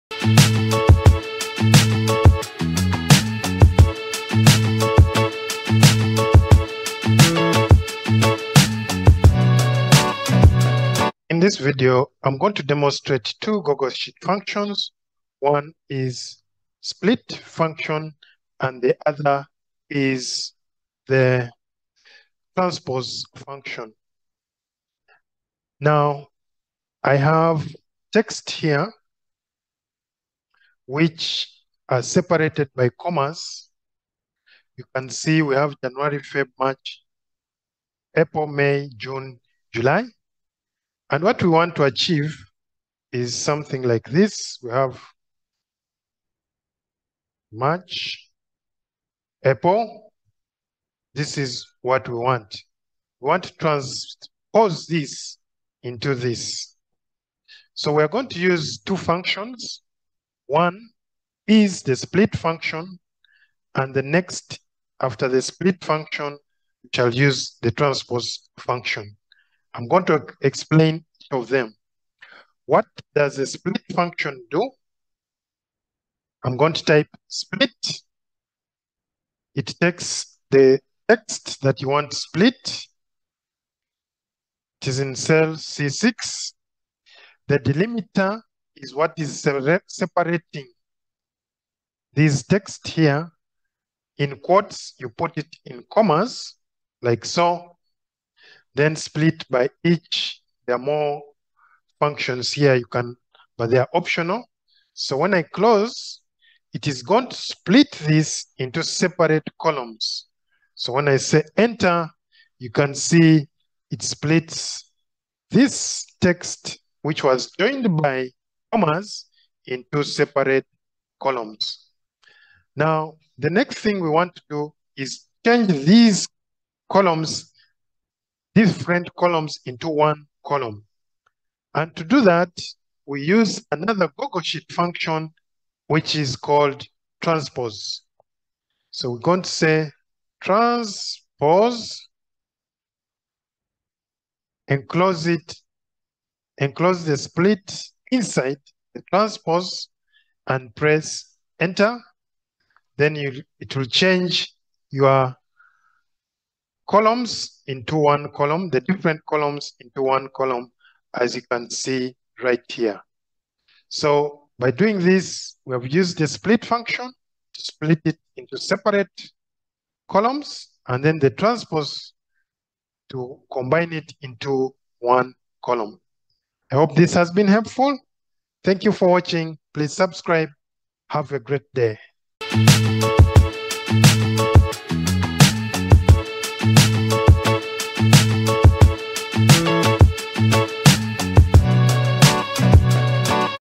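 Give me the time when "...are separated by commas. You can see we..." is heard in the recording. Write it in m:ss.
0:31.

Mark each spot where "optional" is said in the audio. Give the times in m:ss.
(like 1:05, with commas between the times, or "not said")
1:43.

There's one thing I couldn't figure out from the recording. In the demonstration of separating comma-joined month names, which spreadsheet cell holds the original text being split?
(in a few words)
C6.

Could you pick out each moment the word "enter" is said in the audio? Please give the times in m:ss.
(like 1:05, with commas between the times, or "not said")
1:51, 2:31.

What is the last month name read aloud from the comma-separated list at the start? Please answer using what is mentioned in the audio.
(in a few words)
July.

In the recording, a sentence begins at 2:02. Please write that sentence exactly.
Now, the next thing we want to do is change these columns, different columns into one column.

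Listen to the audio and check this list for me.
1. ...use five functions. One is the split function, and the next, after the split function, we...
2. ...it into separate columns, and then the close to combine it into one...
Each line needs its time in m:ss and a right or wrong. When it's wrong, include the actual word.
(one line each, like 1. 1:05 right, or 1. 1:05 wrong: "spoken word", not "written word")
1. 0:58 wrong: "two", not "five"
2. 2:48 wrong: "transpose", not "close".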